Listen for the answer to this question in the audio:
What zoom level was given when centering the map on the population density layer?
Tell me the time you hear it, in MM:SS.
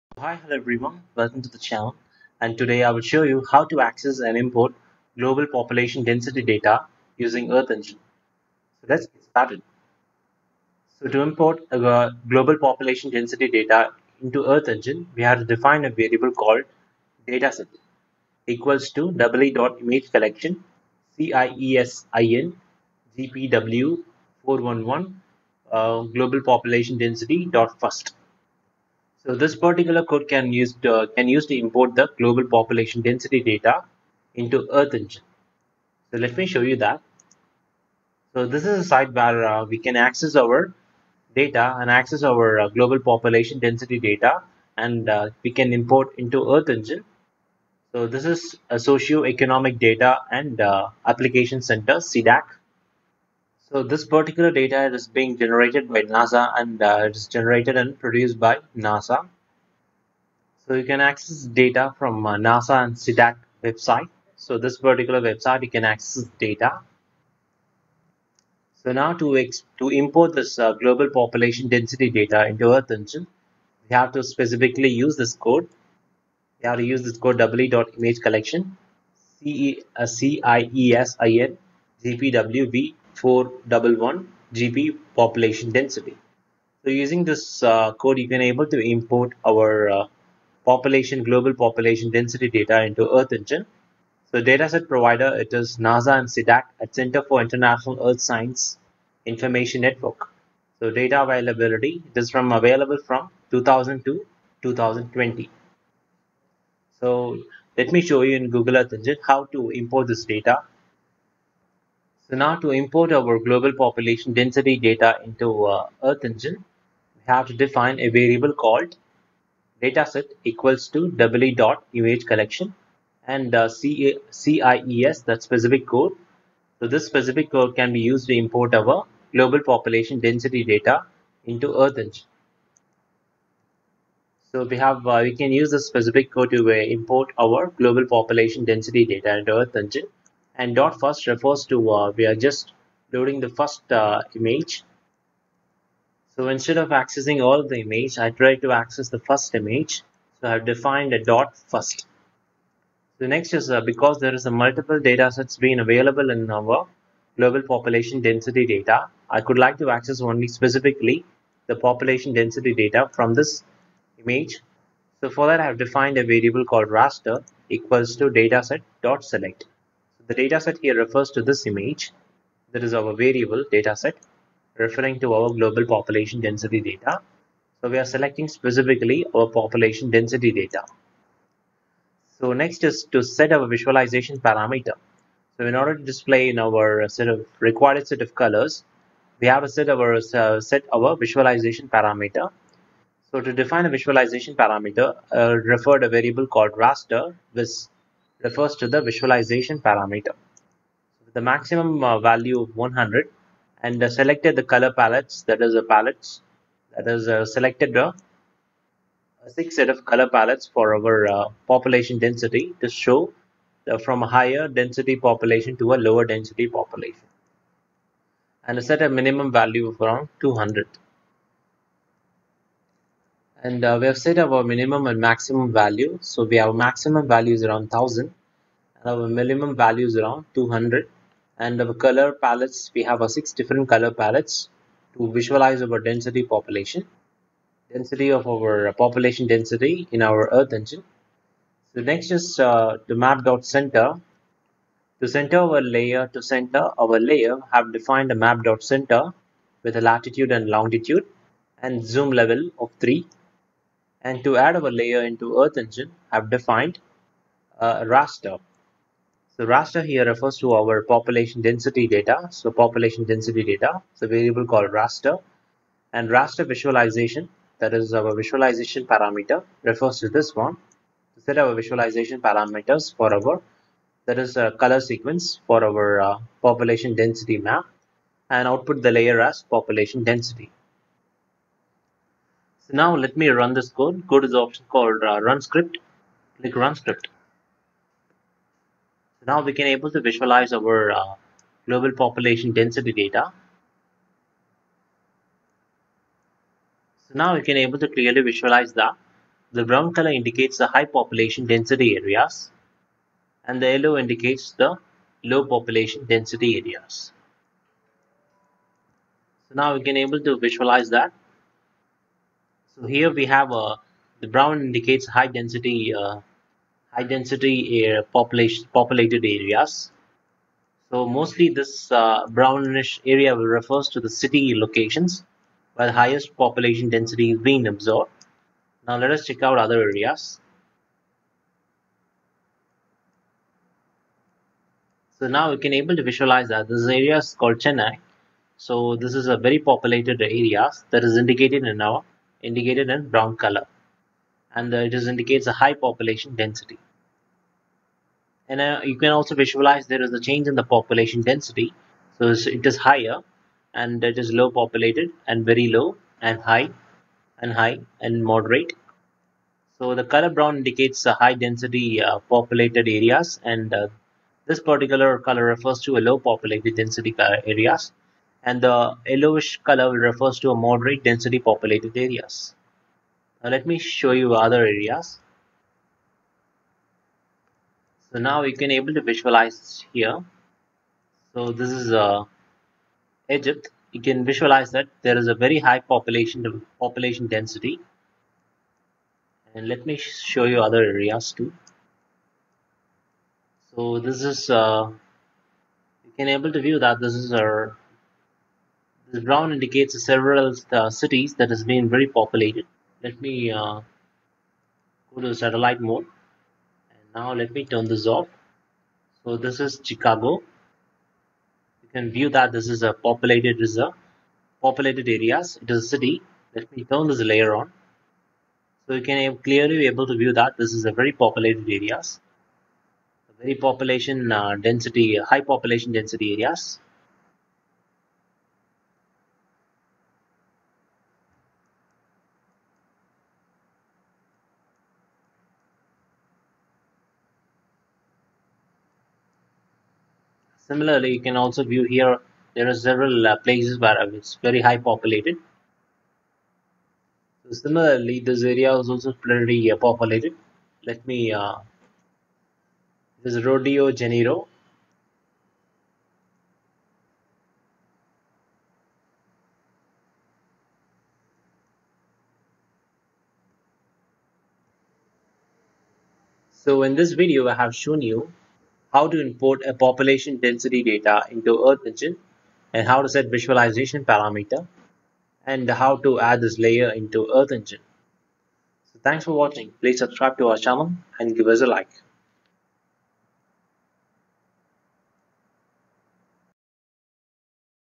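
04:12.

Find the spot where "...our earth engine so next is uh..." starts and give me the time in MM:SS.
04:00.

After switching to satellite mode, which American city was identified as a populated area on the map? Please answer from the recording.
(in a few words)
Chicago.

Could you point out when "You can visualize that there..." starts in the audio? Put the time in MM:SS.
06:24.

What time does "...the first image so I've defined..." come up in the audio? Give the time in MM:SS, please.
02:29.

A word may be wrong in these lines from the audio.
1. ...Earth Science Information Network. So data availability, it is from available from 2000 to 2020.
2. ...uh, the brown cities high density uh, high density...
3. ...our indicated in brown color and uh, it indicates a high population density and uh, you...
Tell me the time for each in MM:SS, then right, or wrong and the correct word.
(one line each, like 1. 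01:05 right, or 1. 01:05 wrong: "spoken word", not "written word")
1. 01:38 right
2. 05:13 wrong: "indicates", not "cities"
3. 05:41 right.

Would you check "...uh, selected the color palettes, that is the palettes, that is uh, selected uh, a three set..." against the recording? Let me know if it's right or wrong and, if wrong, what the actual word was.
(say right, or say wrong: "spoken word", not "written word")
wrong: "six", not "three".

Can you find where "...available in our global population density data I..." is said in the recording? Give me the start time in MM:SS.
02:35.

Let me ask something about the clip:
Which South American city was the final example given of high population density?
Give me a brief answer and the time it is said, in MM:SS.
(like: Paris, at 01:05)
Rio de Janeiro, at 07:33.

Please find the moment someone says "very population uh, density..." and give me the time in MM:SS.
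07:03.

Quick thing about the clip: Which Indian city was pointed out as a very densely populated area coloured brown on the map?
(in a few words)
Chennai.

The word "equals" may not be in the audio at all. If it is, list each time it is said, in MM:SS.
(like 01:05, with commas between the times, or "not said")
00:18, 02:00, 02:47.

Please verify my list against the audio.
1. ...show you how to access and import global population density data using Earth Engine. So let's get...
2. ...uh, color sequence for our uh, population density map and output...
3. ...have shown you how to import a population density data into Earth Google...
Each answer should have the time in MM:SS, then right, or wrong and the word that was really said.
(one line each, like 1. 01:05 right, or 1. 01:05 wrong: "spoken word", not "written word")
1. 00:03 right
2. 04:34 right
3. 07:47 wrong: "Engine", not "Google".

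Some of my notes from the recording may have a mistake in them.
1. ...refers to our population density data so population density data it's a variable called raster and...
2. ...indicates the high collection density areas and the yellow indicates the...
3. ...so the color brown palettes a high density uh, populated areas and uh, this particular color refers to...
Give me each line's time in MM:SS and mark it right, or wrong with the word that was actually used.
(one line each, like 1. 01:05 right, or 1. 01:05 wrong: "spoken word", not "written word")
1. 04:20 right
2. 05:00 wrong: "population", not "collection"
3. 05:59 wrong: "indicates", not "palettes".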